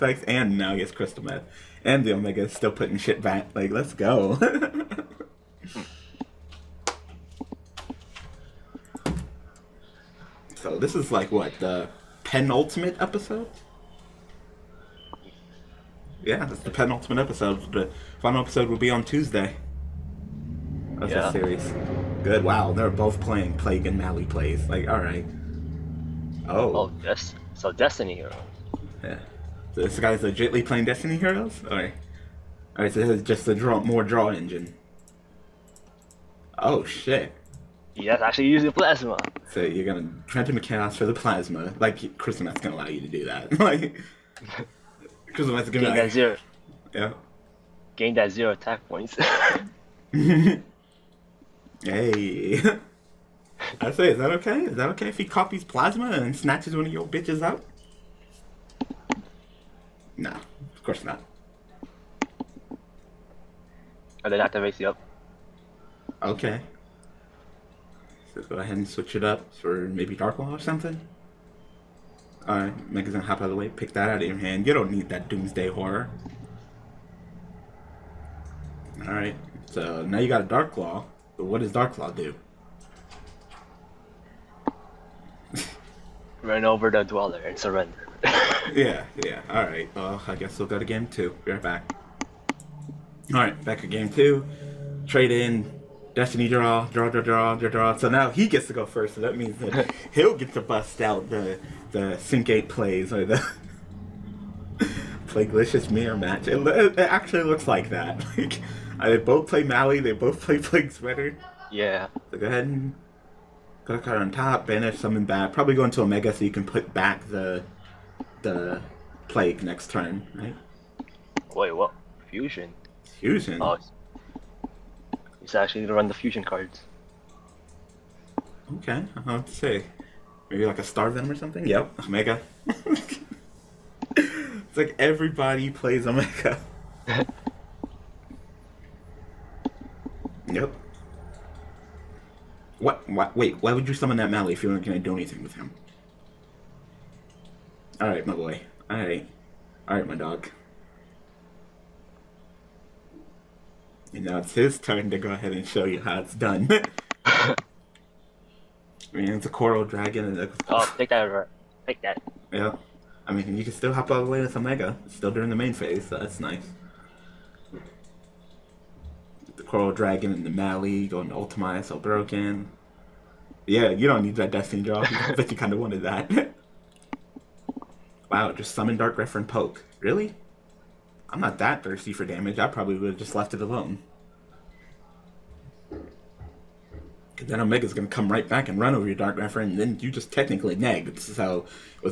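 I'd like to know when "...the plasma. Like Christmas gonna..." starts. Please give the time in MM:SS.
00:41.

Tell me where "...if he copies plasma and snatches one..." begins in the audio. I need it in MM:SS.
00:55.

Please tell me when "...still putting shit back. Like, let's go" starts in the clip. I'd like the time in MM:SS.
00:02.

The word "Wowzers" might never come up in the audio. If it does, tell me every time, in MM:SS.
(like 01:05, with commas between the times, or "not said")
not said.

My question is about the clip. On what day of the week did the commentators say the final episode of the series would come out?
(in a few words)
Tuesday.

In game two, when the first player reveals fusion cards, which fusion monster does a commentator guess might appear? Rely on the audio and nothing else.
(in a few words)
Starve Venom.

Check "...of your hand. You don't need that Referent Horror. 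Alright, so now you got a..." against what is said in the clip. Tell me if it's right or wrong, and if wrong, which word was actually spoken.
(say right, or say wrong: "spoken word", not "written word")
wrong: "Doomsday", not "Referent".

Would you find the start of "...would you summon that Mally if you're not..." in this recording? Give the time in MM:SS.
02:23.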